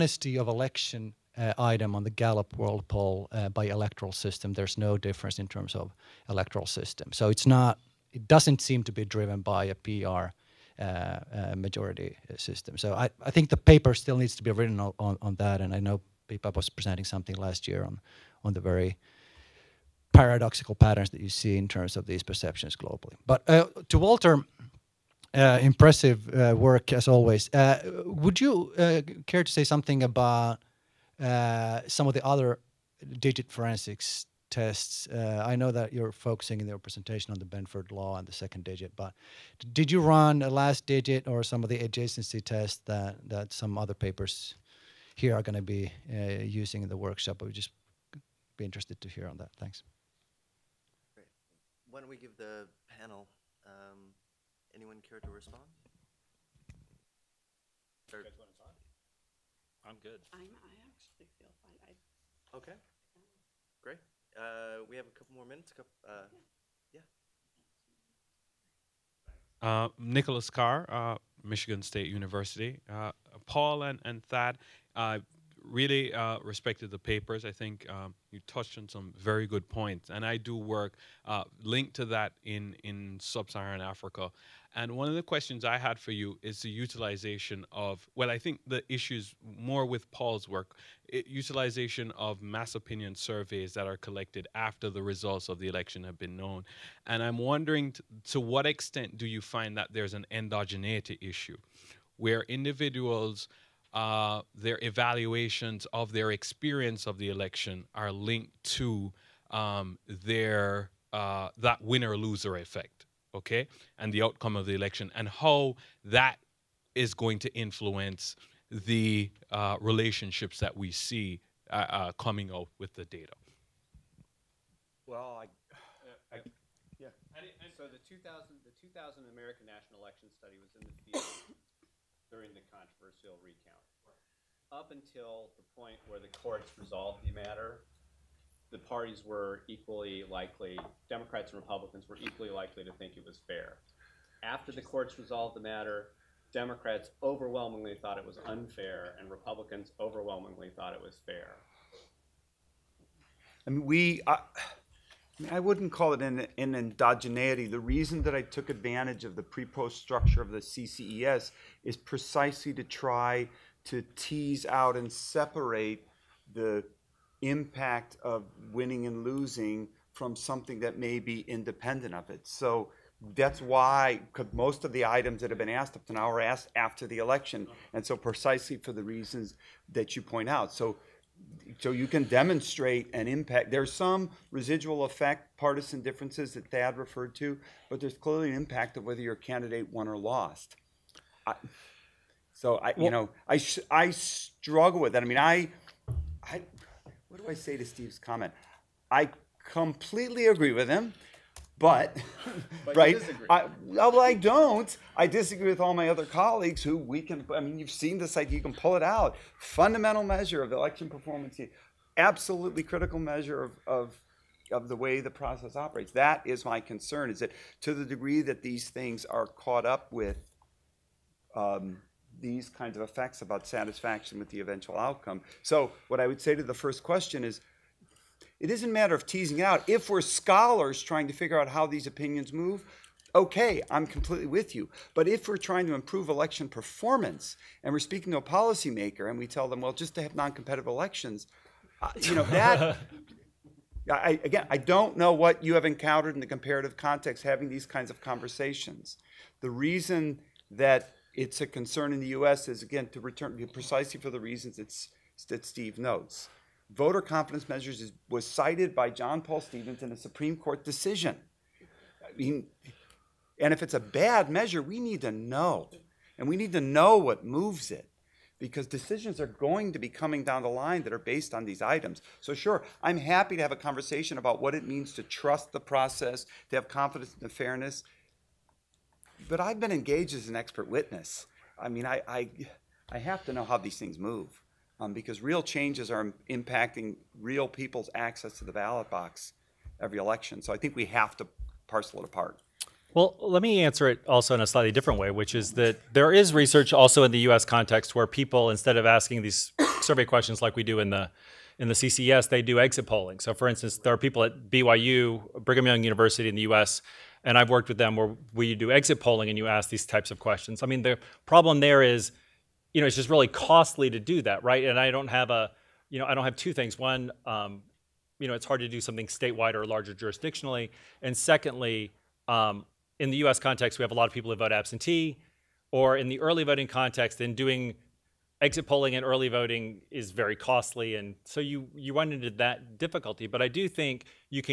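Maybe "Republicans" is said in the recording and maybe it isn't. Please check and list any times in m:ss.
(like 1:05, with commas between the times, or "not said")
2:21, 2:29.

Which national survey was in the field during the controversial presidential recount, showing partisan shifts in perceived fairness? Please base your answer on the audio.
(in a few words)
American National Election Study.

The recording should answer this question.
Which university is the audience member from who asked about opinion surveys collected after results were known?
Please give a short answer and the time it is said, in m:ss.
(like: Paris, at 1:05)
Michigan State University, at 1:11.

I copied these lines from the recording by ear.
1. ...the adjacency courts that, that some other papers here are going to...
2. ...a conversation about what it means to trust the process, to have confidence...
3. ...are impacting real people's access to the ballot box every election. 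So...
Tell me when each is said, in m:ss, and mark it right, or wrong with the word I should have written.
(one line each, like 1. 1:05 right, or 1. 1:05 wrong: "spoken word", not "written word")
1. 0:41 wrong: "tests", not "courts"
2. 4:33 right
3. 4:46 right.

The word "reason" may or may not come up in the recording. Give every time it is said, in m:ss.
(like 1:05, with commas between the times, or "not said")
2:37, 2:59, 4:09, 4:14.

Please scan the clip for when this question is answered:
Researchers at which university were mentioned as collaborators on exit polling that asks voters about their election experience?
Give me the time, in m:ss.
5:05.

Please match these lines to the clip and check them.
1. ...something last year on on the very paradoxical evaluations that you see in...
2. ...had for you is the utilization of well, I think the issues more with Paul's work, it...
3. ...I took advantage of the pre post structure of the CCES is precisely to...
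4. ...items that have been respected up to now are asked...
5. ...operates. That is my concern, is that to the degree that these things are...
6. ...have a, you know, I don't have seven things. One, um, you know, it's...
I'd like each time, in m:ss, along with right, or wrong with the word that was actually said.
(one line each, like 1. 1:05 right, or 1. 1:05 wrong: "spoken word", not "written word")
1. 0:17 wrong: "patterns", not "evaluations"
2. 1:25 right
3. 2:38 right
4. 2:55 wrong: "asked", not "respected"
5. 3:35 right
6. 5:15 wrong: "two", not "seven".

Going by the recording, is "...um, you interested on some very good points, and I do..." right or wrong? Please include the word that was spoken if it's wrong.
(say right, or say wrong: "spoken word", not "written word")
wrong: "touched", not "interested".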